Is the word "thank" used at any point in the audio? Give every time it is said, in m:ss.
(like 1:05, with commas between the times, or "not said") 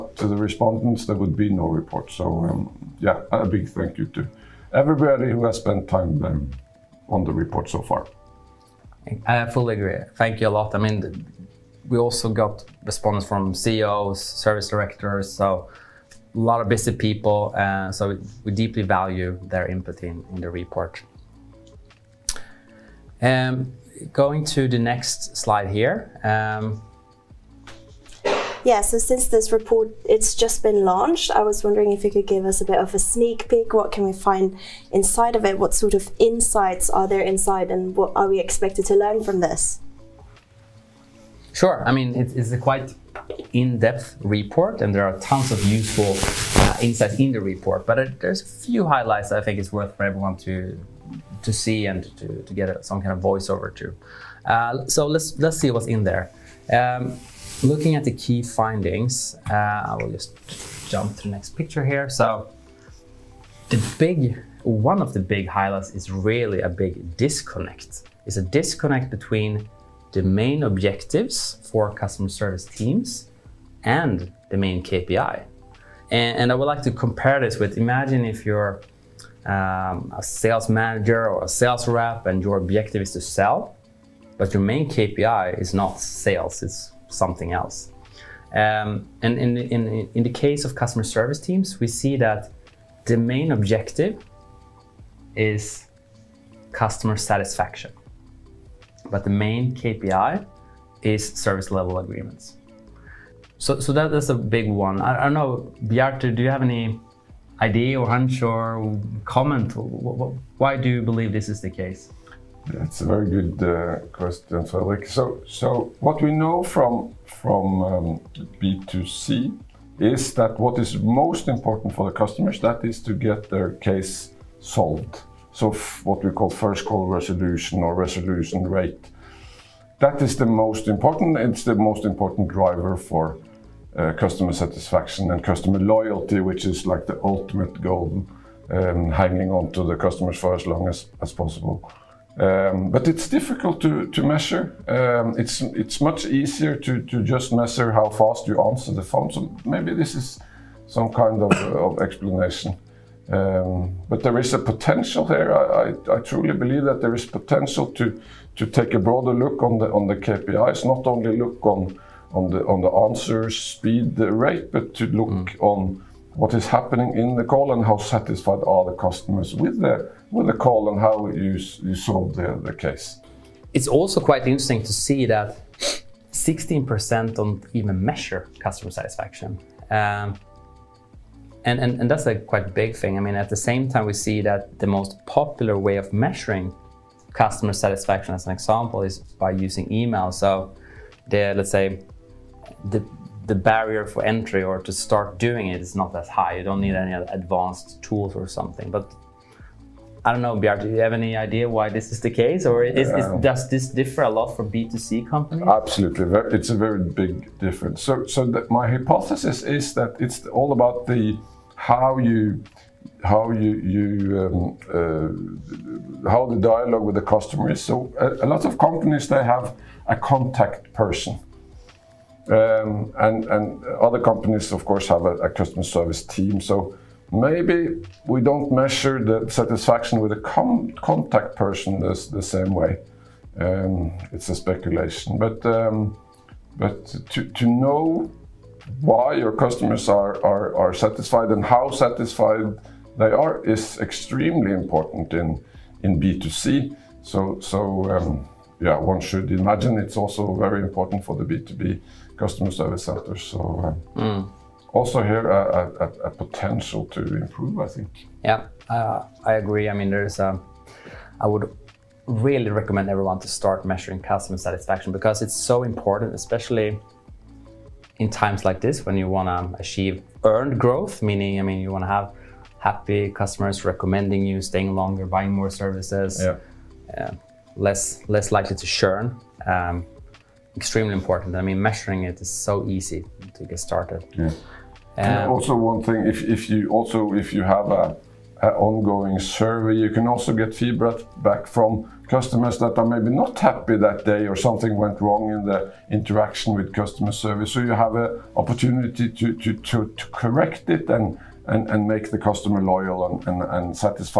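0:03, 0:10.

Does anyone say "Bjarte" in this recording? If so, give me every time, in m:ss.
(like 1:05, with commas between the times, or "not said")
1:45, 3:20.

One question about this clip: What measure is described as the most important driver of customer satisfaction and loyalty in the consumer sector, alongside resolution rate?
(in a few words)
First call resolution.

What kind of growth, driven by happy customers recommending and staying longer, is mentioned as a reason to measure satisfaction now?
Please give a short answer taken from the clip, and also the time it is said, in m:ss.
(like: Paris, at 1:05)
Earned growth, at 4:30.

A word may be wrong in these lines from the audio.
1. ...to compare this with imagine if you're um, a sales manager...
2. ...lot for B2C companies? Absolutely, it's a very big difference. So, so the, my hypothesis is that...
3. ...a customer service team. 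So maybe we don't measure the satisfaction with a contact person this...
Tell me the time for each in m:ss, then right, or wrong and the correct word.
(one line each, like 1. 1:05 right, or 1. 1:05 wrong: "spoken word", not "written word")
1. 1:16 right
2. 3:24 right
3. 3:45 right.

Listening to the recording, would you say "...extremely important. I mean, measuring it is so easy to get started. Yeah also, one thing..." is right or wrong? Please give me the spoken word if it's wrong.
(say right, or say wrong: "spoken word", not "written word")
right.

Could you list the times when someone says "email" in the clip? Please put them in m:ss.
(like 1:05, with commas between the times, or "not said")
3:09.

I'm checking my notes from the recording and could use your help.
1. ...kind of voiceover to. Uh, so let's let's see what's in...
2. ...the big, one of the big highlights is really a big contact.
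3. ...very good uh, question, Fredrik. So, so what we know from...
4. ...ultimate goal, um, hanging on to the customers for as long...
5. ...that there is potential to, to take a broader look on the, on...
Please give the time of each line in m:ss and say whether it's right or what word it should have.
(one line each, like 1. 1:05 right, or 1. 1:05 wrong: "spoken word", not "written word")
1. 0:53 right
2. 1:03 wrong: "disconnect", not "contact"
3. 1:53 right
4. 2:17 right
5. 2:36 right.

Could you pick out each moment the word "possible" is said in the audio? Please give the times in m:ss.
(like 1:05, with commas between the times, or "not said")
2:21.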